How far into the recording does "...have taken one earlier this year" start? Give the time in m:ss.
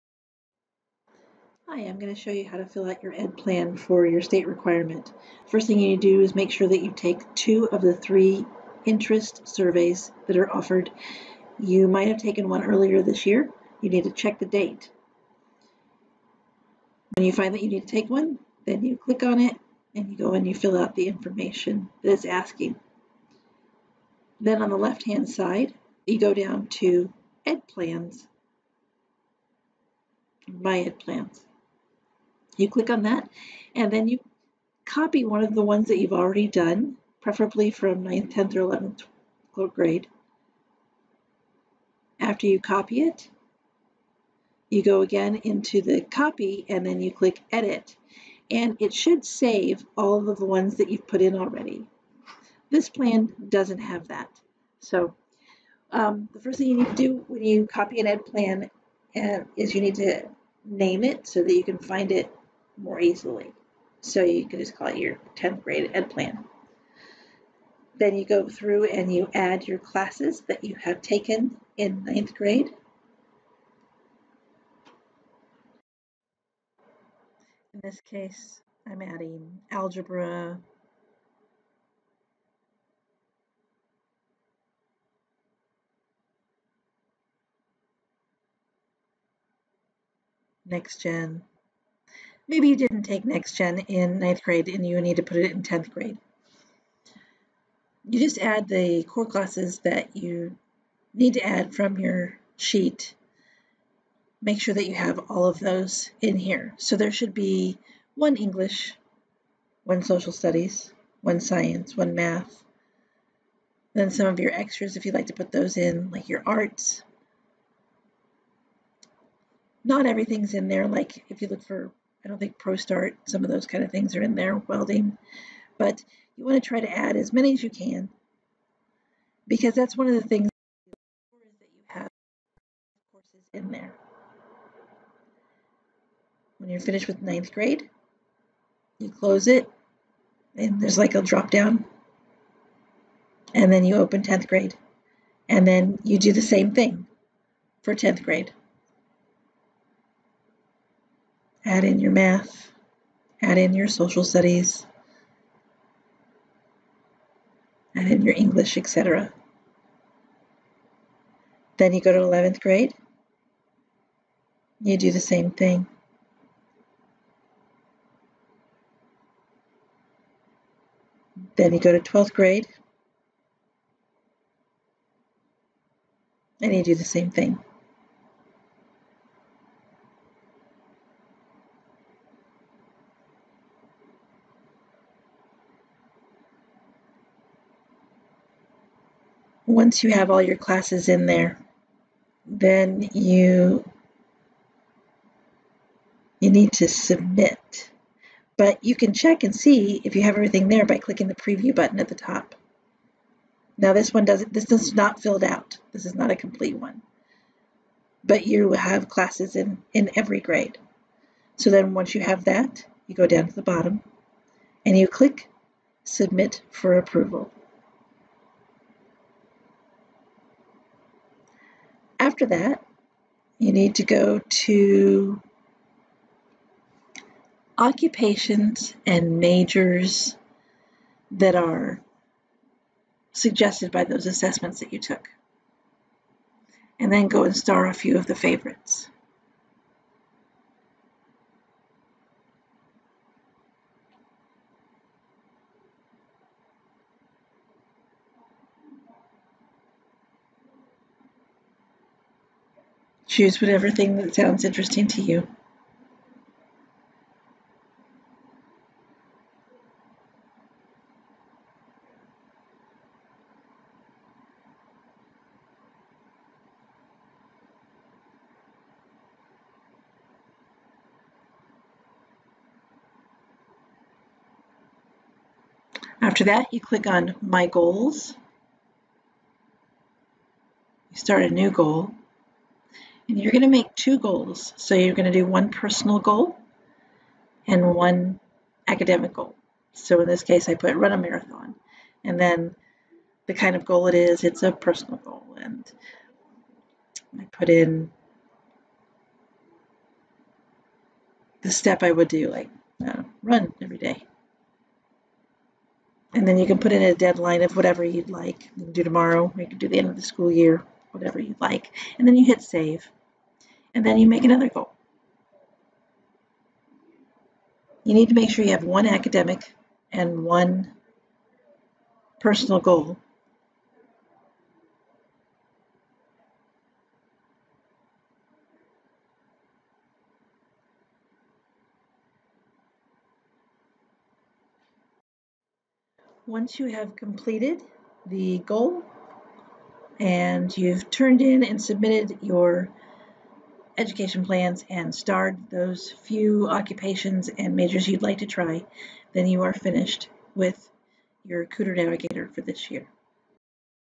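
0:12.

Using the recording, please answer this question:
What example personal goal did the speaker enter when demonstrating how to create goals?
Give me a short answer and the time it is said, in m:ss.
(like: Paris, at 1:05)
run a marathon, at 4:50.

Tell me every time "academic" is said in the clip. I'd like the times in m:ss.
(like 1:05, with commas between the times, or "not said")
4:48, 5:19.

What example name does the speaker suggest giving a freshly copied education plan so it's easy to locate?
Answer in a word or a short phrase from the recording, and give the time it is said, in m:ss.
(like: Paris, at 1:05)
10th grade ed plan, at 1:05.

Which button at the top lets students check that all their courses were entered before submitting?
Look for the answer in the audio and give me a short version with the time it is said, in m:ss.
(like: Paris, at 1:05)
preview, at 3:21.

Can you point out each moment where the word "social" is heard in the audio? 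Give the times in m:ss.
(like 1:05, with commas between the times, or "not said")
1:50, 2:33.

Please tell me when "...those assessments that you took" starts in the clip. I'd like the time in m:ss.
3:54.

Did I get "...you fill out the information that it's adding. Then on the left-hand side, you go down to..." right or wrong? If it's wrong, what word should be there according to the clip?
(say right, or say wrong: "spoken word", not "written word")
wrong: "asking", not "adding".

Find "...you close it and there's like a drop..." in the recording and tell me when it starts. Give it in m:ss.
2:18.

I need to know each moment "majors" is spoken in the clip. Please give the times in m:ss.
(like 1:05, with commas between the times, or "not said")
3:49, 5:47.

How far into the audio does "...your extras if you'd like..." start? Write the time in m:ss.
1:54.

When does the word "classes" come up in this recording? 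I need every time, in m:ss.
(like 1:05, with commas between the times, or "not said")
1:09, 1:39, 3:10, 3:29.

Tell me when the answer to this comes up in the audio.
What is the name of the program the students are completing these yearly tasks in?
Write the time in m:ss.
5:51.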